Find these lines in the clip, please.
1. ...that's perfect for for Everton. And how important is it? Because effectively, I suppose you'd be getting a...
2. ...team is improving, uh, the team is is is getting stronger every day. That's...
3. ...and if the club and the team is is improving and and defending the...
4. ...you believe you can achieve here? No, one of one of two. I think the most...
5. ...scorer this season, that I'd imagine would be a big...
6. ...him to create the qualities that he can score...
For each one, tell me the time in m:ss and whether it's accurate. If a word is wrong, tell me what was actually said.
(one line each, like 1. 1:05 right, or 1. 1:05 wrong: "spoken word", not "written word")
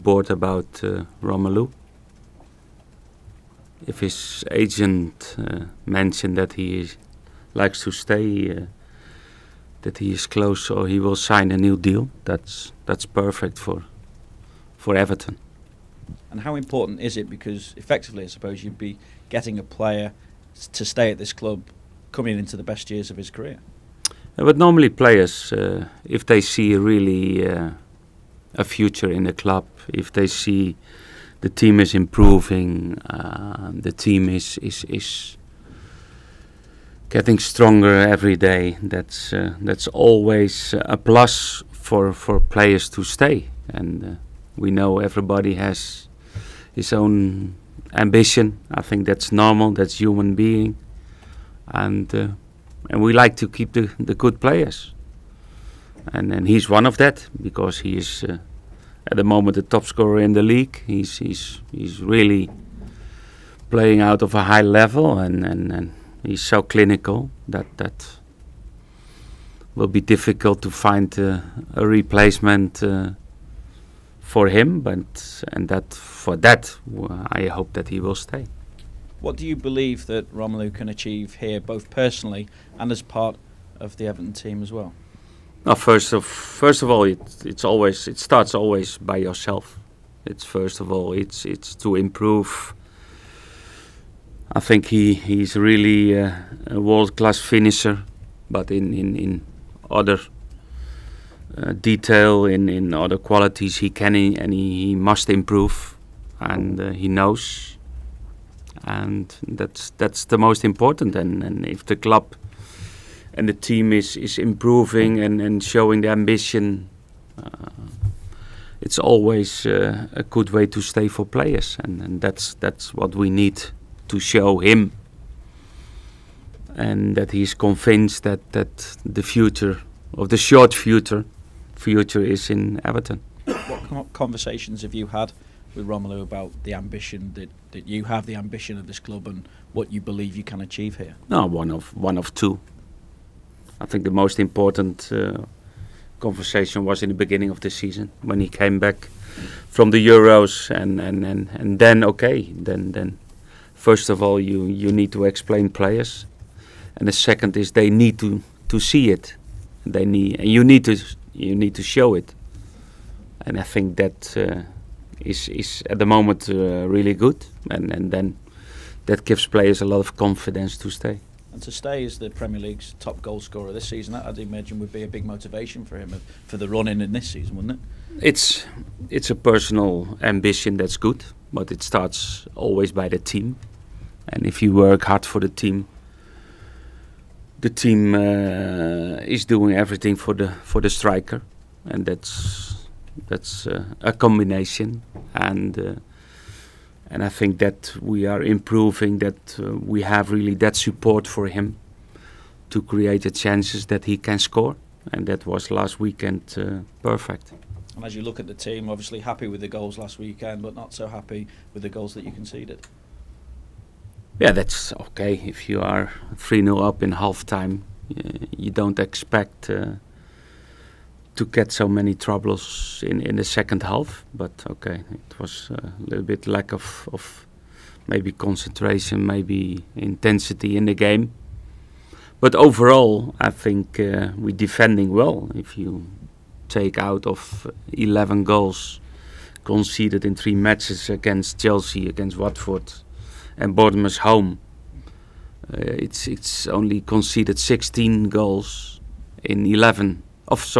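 1. 0:12 right
2. 0:31 right
3. 1:51 wrong: "showing", not "defending"
4. 2:19 right
5. 2:53 right
6. 3:21 wrong: "chances", not "qualities".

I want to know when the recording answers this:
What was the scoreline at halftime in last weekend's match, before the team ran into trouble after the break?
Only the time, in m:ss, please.
3:36.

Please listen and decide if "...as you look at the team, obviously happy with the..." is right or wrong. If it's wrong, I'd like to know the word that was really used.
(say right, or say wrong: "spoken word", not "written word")
right.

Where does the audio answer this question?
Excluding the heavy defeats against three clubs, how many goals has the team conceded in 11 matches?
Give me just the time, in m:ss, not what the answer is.
4:07.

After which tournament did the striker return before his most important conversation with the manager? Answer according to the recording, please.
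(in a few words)
the Euros.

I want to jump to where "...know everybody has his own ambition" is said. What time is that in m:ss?
0:44.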